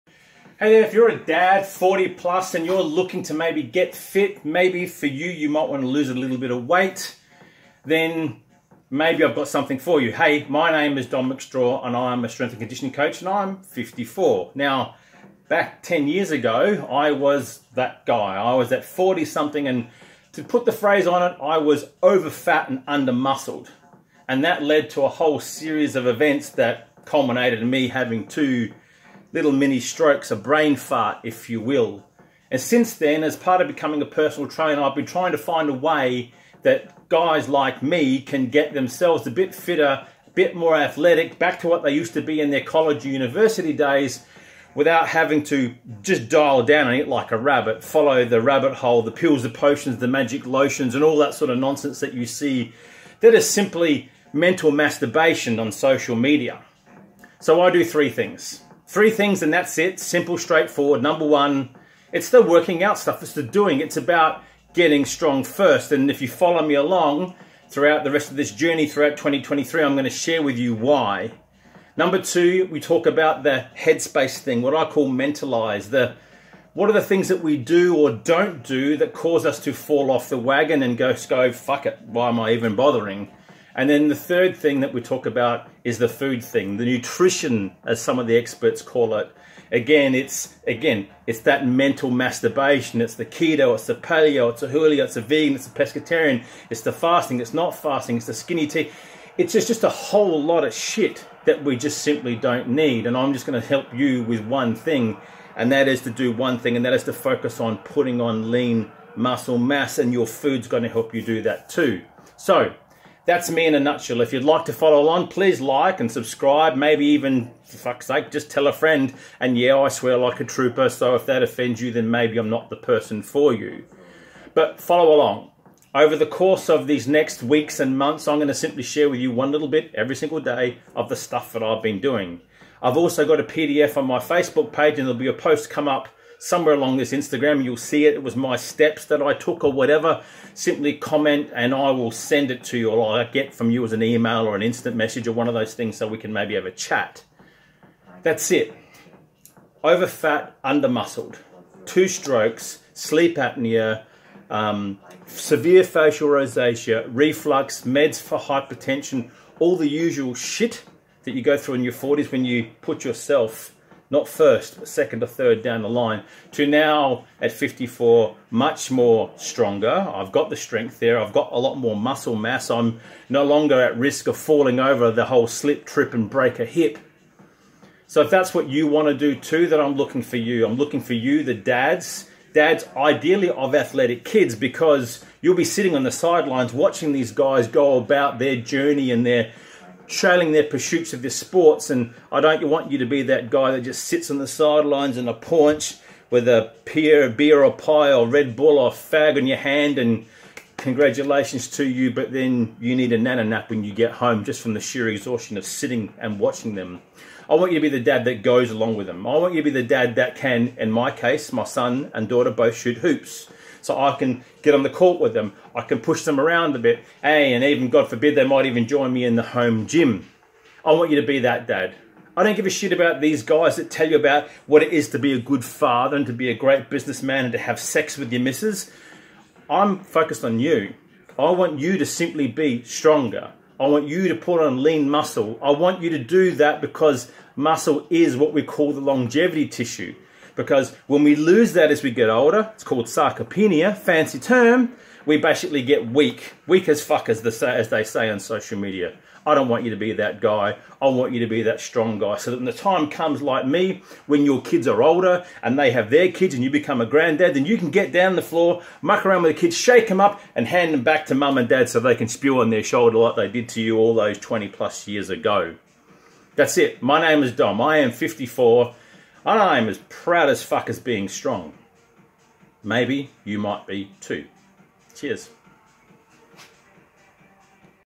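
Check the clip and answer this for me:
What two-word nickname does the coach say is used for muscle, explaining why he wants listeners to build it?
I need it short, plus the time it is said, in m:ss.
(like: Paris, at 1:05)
longevity tissue, at 3:59.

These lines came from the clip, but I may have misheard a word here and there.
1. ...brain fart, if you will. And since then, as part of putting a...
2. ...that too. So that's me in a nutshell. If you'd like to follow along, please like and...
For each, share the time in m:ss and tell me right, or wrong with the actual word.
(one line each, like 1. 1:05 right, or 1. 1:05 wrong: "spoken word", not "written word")
1. 0:30 wrong: "becoming", not "putting"
2. 1:51 right.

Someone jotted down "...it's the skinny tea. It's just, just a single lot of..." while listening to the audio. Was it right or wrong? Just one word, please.
wrong.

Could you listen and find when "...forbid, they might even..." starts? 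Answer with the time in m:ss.
3:38.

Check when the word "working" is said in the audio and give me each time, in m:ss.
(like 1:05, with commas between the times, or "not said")
1:02.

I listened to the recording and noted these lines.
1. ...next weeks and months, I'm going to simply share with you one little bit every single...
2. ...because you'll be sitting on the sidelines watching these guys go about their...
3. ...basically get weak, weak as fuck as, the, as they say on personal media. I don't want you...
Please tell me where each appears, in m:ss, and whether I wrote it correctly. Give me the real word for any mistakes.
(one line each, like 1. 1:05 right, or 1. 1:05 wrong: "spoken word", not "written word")
1. 2:07 right
2. 3:04 right
3. 4:05 wrong: "social", not "personal".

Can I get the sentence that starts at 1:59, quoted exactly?
And yeah, I swear like a trooper, so if that offends you, then maybe I'm not the person for you.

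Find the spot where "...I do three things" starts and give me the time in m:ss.
0:57.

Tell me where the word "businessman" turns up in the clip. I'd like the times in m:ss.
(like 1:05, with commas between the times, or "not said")
3:46.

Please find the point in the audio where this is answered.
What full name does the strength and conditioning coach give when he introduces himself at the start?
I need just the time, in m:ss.
0:11.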